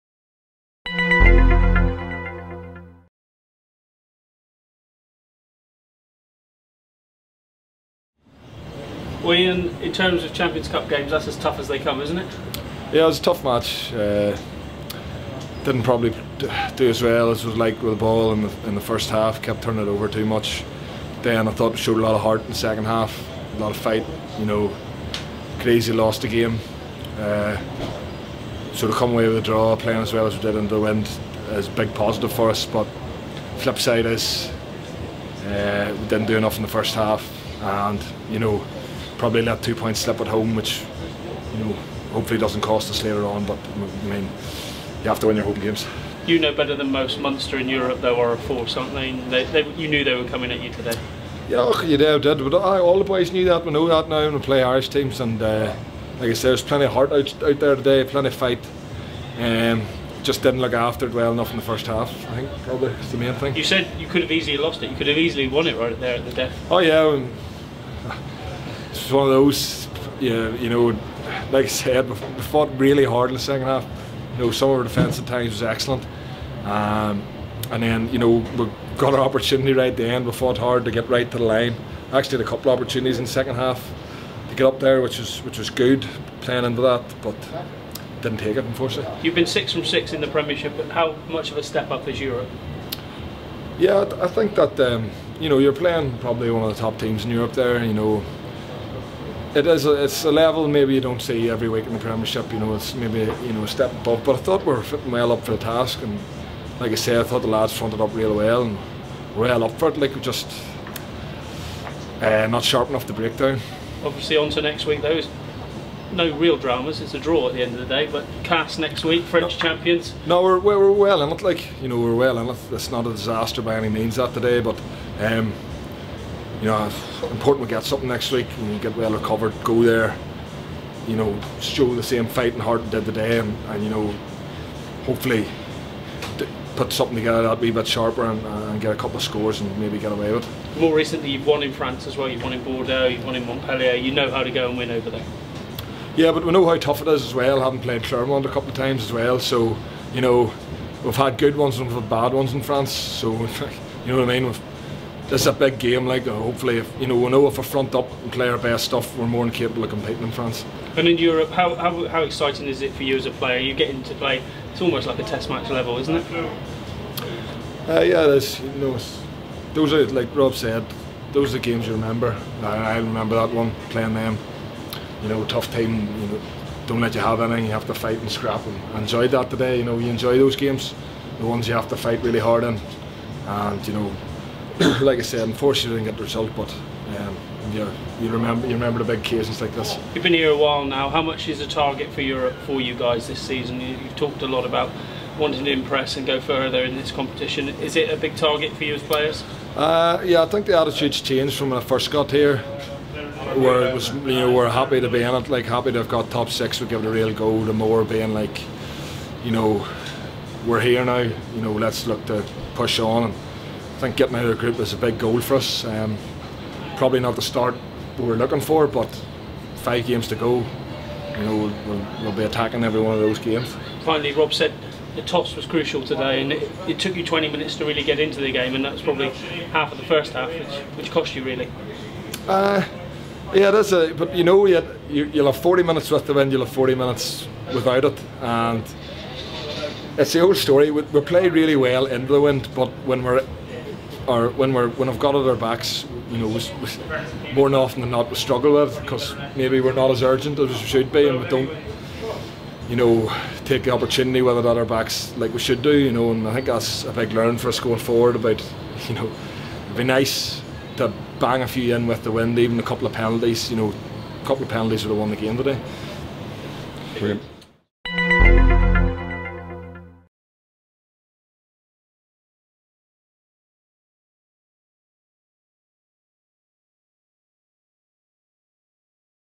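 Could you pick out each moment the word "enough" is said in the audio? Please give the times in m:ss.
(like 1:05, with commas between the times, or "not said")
0:36, 1:01, 1:52.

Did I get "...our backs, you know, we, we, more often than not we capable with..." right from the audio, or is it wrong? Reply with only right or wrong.
wrong.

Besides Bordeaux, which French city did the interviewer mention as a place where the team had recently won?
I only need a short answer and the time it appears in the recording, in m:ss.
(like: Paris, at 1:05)
Montpellier, at 2:23.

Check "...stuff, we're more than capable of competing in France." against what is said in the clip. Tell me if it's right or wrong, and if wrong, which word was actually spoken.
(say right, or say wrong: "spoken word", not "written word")
right.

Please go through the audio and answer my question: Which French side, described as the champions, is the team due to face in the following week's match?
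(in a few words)
Castres.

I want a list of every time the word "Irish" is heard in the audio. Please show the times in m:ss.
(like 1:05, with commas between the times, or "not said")
0:54.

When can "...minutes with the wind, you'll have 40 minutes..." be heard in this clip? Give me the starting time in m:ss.
3:55.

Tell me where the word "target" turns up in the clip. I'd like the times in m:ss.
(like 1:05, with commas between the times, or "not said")
3:11, 3:18.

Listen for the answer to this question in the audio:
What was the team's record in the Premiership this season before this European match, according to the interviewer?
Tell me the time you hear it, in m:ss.
1:29.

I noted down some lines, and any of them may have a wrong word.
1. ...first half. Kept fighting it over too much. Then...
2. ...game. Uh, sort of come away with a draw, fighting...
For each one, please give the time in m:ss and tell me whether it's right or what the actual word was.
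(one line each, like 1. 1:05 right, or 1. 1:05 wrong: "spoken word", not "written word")
1. 0:18 wrong: "turning", not "fighting"
2. 0:26 wrong: "playing", not "fighting".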